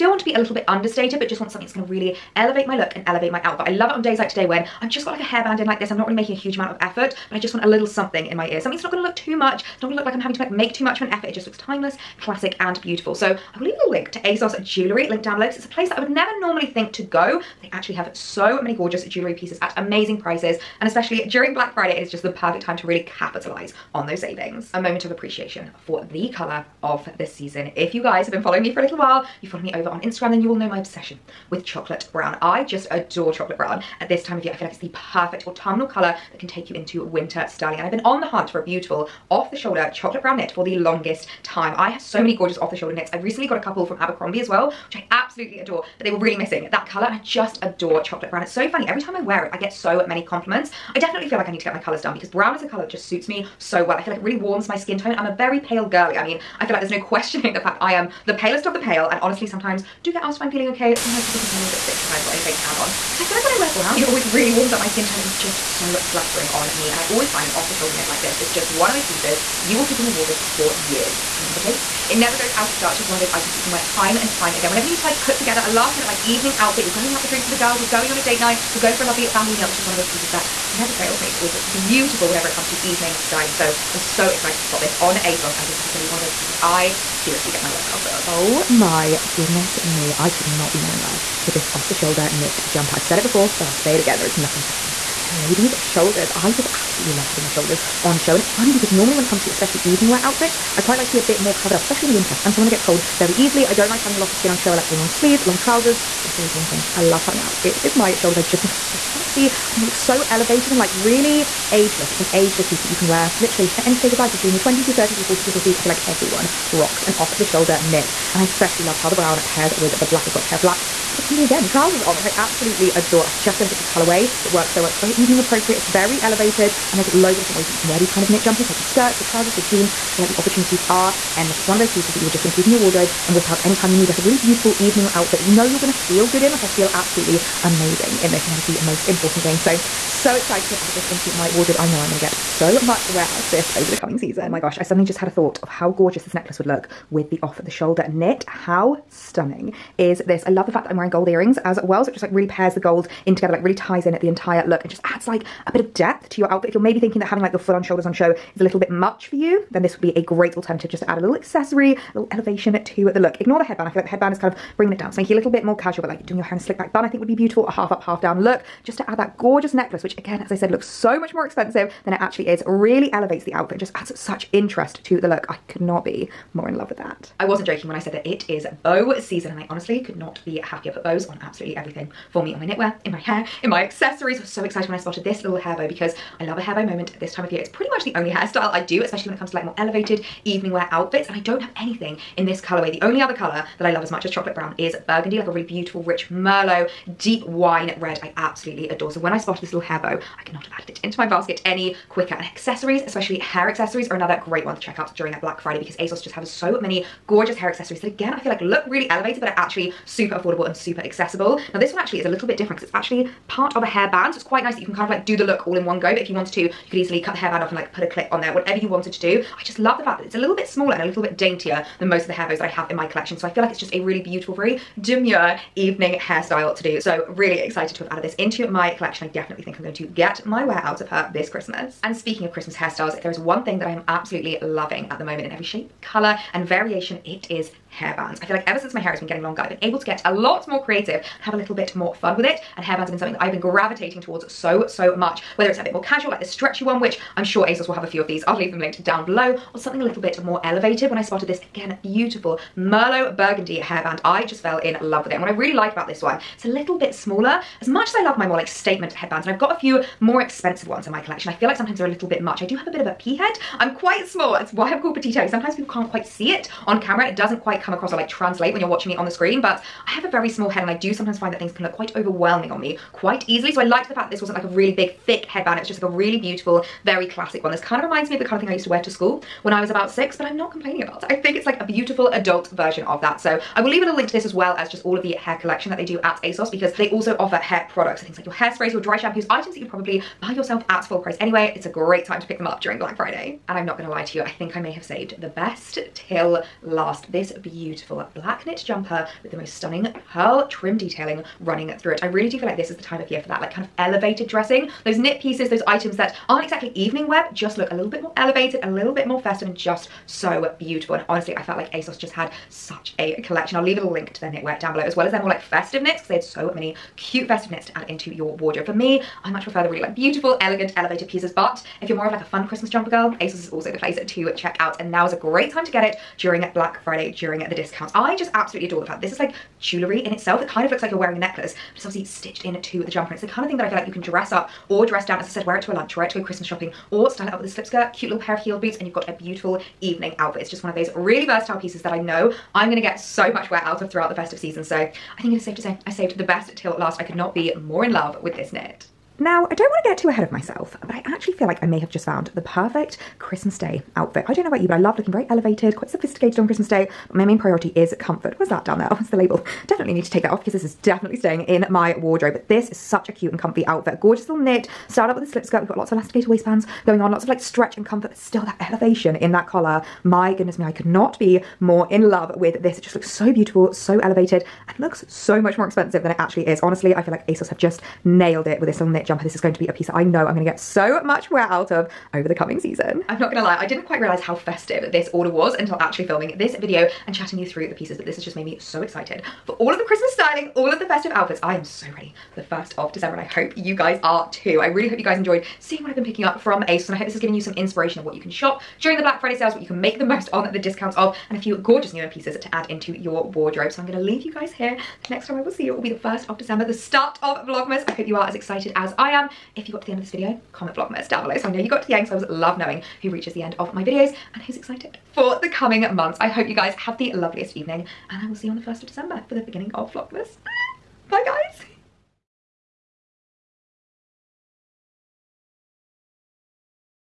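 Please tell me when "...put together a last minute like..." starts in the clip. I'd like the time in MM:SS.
01:15.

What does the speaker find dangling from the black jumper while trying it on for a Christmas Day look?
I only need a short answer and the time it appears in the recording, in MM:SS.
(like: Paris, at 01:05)
the label, at 05:59.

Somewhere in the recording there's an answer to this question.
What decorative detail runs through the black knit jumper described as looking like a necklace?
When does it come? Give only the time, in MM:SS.
05:00.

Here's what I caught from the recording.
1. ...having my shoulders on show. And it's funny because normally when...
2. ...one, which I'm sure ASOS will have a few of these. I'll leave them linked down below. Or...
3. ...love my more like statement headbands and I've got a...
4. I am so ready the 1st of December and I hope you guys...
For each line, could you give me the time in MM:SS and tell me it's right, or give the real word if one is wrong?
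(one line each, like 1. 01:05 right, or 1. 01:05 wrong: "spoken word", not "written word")
1. 01:37 right
2. 04:06 right
3. 04:18 right
4. 06:31 right.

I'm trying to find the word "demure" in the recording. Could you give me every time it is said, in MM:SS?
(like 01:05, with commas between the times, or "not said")
03:45.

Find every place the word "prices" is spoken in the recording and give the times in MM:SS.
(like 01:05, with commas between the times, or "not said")
00:20, 04:51.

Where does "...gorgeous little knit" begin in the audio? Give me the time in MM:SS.
06:04.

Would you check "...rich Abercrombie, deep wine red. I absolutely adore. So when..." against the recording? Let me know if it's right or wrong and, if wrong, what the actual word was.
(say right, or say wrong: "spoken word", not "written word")
wrong: "Merlot", not "Abercrombie".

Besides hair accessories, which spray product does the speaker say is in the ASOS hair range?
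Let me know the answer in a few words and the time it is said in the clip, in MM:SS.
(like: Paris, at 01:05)
hairsprays, at 04:48.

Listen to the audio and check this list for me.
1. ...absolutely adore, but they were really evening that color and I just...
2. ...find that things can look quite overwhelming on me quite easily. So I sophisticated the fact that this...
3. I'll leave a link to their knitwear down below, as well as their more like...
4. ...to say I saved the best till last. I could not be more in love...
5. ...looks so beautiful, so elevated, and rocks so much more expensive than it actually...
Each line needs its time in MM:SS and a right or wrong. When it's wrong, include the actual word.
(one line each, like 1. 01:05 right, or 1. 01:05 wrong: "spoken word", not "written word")
1. 00:45 wrong: "missing", not "evening"
2. 04:31 wrong: "liked", not "sophisticated"
3. 05:13 right
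4. 05:45 right
5. 06:13 wrong: "looks", not "rocks".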